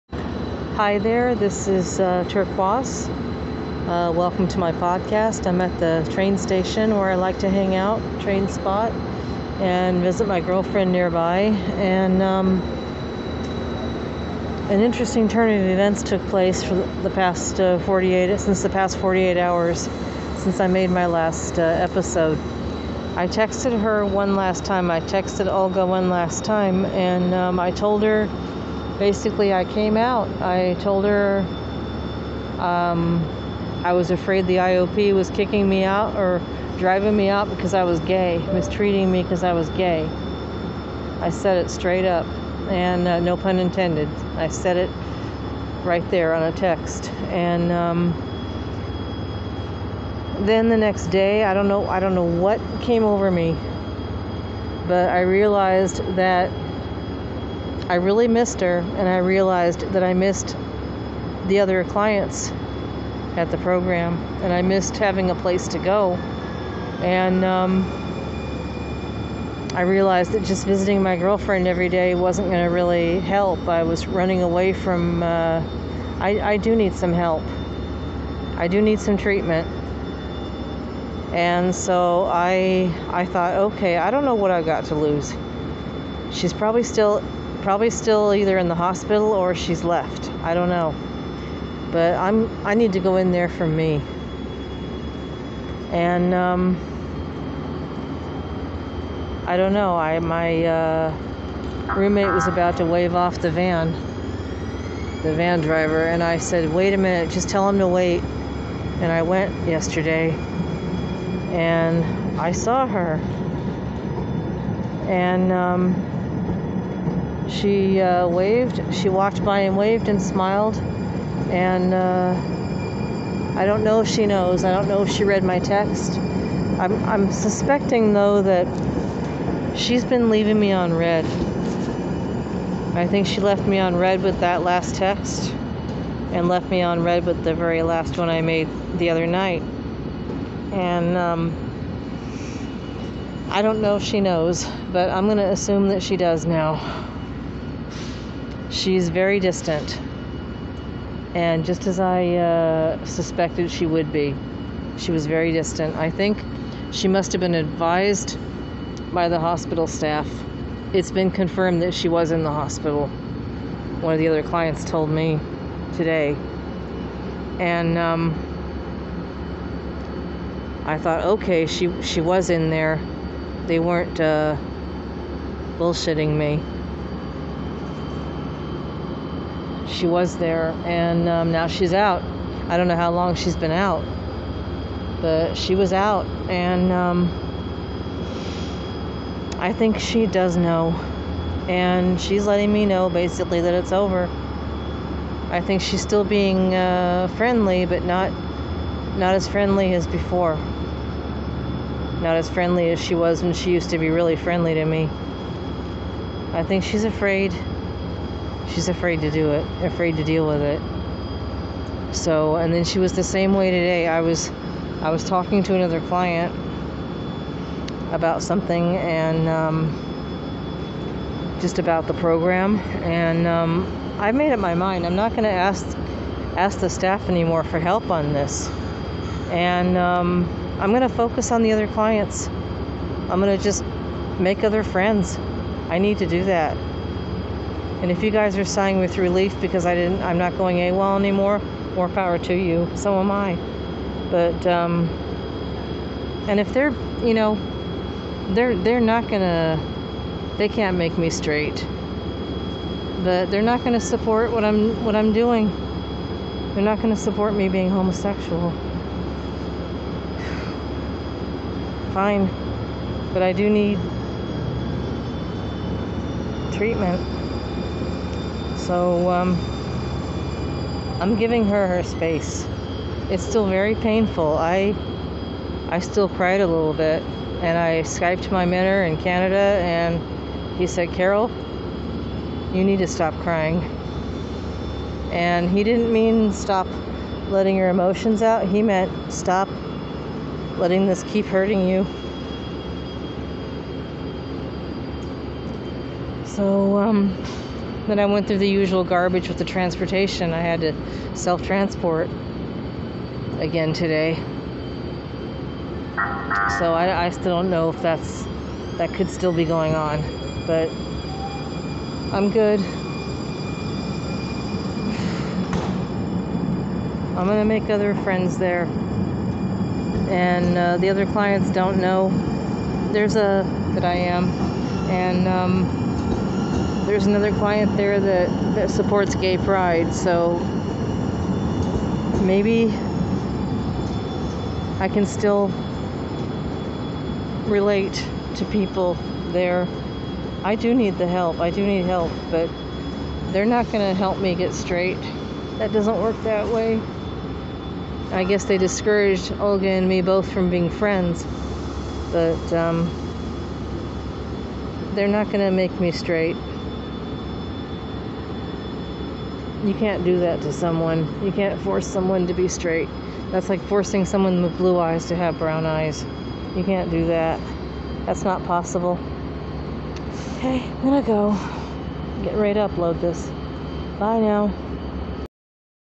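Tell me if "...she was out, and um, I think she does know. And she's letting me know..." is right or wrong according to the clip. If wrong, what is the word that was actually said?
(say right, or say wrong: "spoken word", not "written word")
right.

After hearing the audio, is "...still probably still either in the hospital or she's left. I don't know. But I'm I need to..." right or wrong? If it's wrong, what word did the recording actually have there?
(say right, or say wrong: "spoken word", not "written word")
right.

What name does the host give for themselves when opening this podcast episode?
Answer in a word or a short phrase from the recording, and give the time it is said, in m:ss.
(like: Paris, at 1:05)
Turquoise, at 0:02.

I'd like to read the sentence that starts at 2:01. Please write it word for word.
And uh, I don't know if she knows.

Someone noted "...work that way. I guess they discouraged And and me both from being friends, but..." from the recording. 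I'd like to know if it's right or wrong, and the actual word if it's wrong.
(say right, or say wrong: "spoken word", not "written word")
wrong: "Olga", not "And".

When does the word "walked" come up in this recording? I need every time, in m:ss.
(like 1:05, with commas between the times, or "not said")
1:59.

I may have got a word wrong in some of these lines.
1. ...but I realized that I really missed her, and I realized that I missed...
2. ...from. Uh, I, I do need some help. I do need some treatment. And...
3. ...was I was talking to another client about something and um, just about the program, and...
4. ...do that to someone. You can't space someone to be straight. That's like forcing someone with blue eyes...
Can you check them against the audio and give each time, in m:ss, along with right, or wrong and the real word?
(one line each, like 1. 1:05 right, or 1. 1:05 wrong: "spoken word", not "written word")
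1. 0:54 right
2. 1:14 right
3. 3:34 right
4. 6:00 wrong: "force", not "space".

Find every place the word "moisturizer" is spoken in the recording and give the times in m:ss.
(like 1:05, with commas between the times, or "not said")
not said.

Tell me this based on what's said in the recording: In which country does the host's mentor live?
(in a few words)
Canada.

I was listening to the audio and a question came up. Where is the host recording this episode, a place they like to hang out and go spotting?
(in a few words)
Train station.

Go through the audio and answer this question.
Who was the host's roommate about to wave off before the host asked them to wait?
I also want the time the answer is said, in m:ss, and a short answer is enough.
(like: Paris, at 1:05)
The van driver, at 1:45.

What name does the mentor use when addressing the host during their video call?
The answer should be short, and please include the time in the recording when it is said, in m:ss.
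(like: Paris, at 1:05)
Carol, at 4:41.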